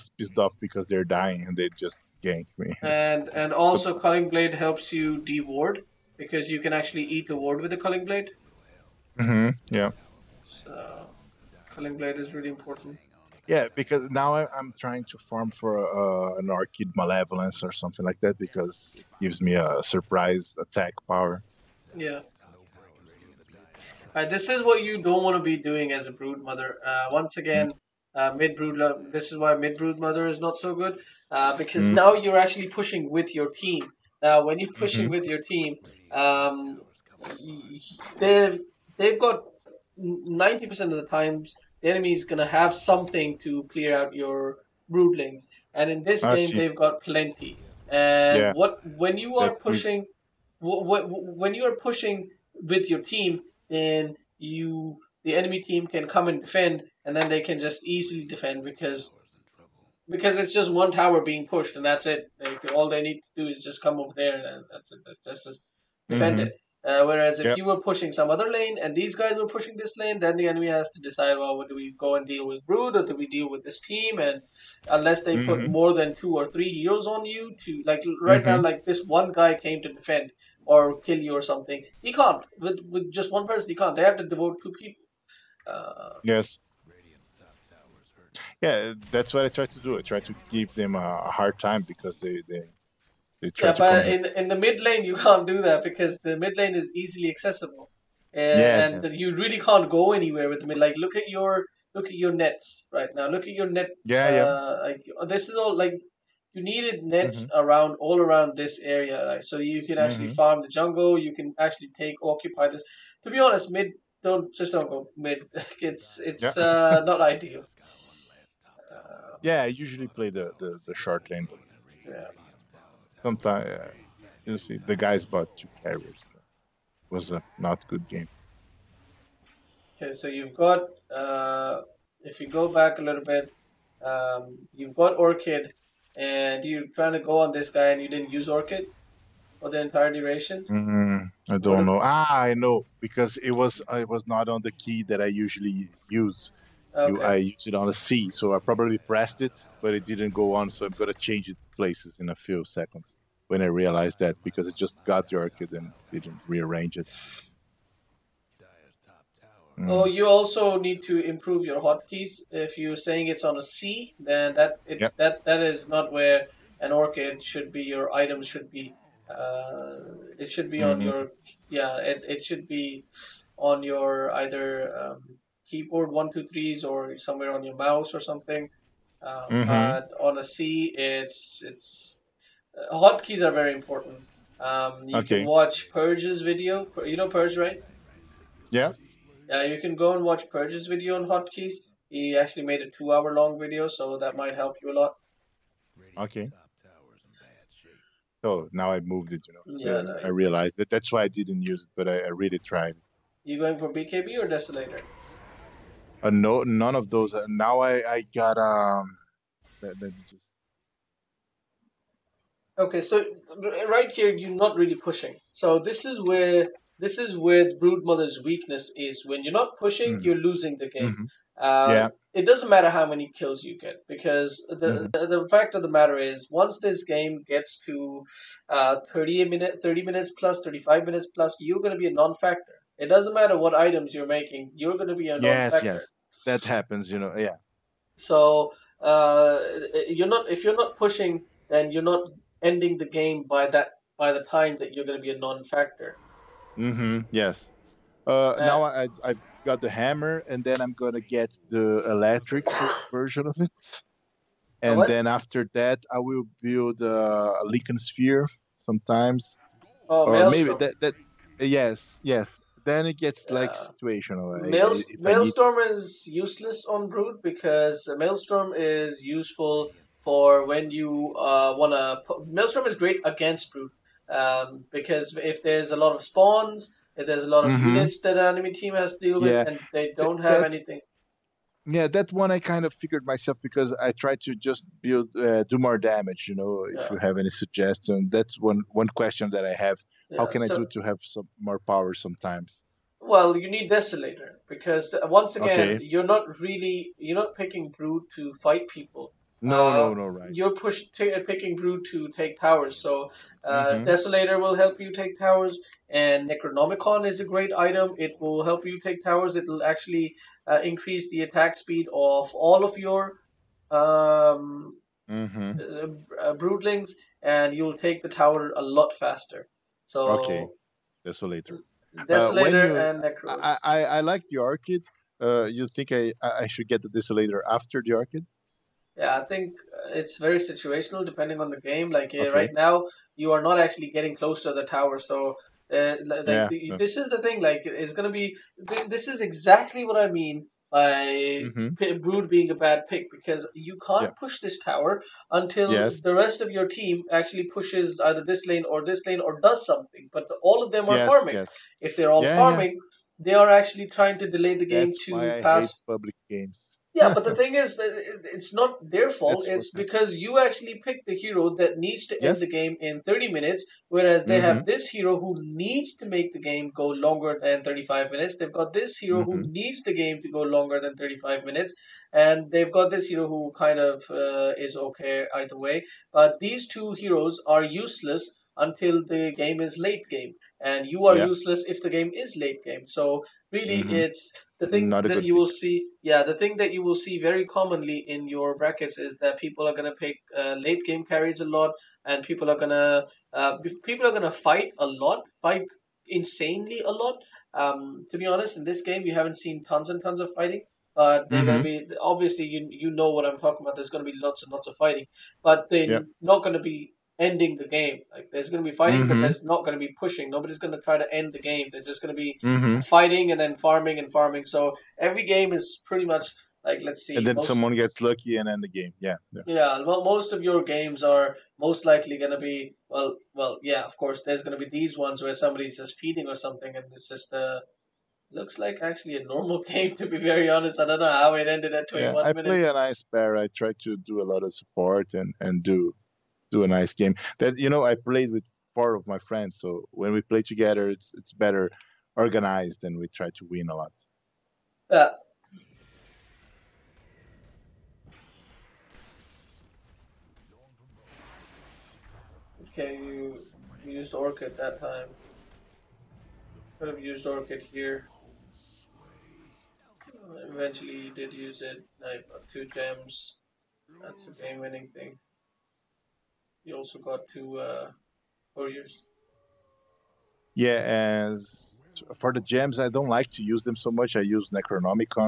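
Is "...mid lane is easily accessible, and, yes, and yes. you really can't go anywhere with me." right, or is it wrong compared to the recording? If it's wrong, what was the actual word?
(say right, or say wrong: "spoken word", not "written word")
right.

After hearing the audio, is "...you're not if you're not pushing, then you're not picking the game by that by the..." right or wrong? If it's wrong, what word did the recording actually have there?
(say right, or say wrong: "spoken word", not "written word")
wrong: "ending", not "picking".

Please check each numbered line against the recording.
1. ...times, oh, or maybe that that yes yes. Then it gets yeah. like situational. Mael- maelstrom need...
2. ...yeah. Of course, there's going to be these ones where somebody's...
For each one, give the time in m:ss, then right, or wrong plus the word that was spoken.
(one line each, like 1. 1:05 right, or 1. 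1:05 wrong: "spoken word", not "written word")
1. 4:18 wrong: "sometimes", not "times"
2. 7:03 right.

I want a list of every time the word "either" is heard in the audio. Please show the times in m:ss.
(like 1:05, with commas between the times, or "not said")
2:54, 5:48, 6:15.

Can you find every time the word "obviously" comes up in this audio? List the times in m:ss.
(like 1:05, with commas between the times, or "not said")
6:42.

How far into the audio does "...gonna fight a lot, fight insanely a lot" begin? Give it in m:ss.
6:34.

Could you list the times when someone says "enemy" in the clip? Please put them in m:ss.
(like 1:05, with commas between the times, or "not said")
0:41, 0:55, 1:10, 4:38.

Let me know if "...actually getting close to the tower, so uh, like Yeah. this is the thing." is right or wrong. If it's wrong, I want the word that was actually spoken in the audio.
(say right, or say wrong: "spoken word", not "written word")
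right.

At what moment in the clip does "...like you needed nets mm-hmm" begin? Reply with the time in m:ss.
1:45.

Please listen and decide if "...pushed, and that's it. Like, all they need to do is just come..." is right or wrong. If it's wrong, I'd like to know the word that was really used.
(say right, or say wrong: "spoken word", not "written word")
right.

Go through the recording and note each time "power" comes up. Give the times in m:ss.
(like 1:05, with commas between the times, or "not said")
0:21, 4:51.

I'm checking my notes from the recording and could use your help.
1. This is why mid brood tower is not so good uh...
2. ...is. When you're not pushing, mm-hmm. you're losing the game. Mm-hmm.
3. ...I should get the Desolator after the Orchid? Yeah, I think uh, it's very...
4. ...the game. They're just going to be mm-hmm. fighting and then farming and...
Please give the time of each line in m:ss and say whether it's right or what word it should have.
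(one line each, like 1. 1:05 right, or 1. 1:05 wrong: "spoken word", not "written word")
1. 0:29 wrong: "mother", not "tower"
2. 3:38 right
3. 5:26 right
4. 6:51 right.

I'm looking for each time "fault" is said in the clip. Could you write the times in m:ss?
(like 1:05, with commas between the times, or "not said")
5:59.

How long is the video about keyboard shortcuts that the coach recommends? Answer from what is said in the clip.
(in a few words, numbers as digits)
2 hours.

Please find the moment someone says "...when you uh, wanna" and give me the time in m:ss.
4:30.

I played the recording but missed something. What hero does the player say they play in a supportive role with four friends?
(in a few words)
Bear.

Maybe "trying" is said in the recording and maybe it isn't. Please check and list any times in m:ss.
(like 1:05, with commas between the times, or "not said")
0:14, 2:16, 5:54.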